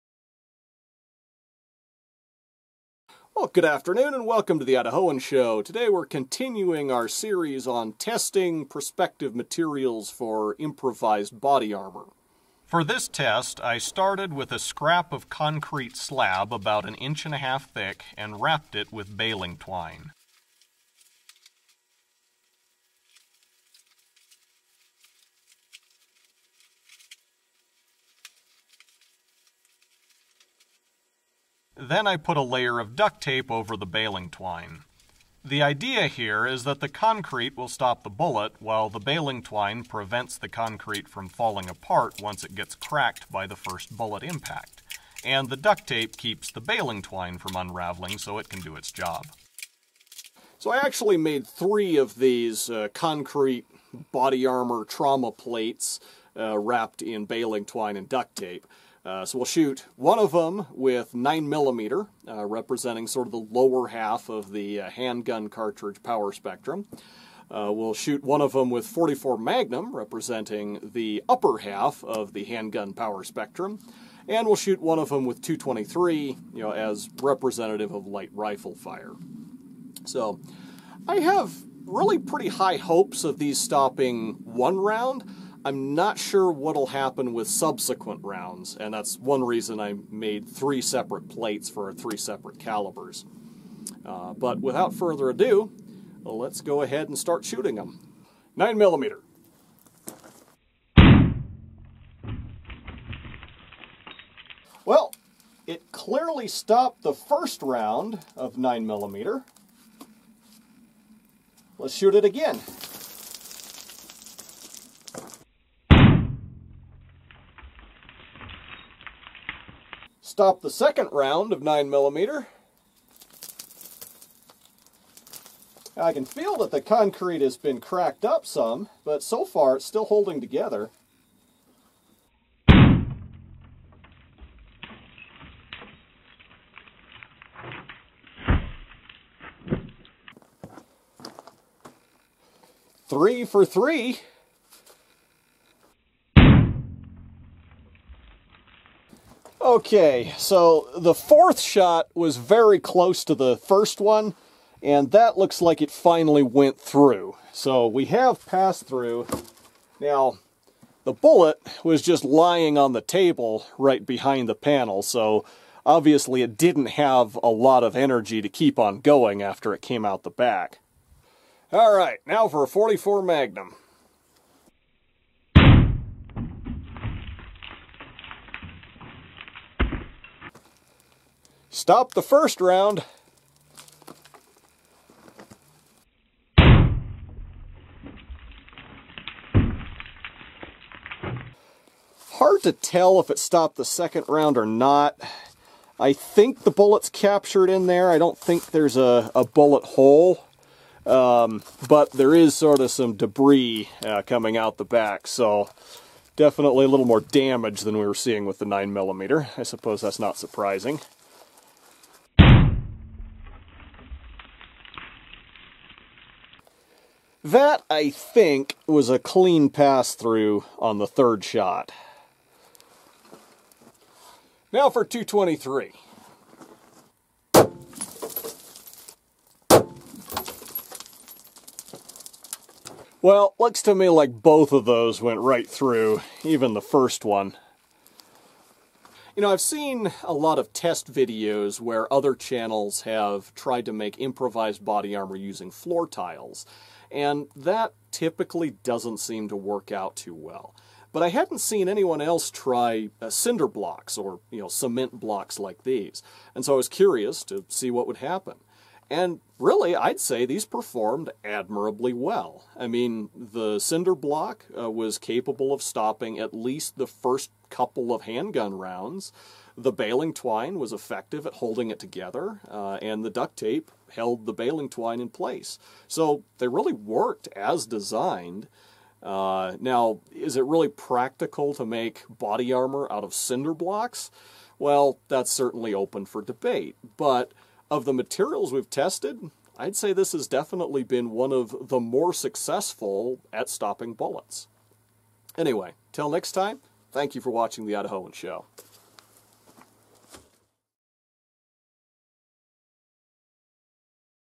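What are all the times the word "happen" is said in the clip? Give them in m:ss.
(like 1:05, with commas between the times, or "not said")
1:26, 4:18.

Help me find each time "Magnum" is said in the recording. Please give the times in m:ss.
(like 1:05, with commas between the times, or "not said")
1:09, 2:53.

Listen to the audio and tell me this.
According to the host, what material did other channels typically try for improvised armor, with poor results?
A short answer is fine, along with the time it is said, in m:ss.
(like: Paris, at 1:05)
Floor tiles, at 4:05.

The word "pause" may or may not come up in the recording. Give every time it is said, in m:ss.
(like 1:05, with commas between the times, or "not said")
not said.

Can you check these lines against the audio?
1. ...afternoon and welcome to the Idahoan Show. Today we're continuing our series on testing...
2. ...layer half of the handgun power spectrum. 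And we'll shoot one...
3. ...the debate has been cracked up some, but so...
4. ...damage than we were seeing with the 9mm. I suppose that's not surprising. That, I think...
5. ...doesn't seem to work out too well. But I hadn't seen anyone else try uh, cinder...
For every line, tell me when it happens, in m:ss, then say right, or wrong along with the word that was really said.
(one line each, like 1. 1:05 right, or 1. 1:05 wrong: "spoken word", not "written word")
1. 0:03 right
2. 1:11 wrong: "upper", not "layer"
3. 2:06 wrong: "concrete", not "debate"
4. 3:27 right
5. 4:08 right.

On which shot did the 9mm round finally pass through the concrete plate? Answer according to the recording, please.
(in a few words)
Fourth.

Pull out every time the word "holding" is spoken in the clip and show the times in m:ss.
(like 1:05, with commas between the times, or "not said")
2:10, 4:31.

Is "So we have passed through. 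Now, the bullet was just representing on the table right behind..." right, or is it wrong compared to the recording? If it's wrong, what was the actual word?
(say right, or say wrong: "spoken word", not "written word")
wrong: "lying", not "representing".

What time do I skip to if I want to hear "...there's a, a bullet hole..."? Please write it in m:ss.
3:18.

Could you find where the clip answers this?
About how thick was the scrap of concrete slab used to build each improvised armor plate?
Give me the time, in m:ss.
0:16.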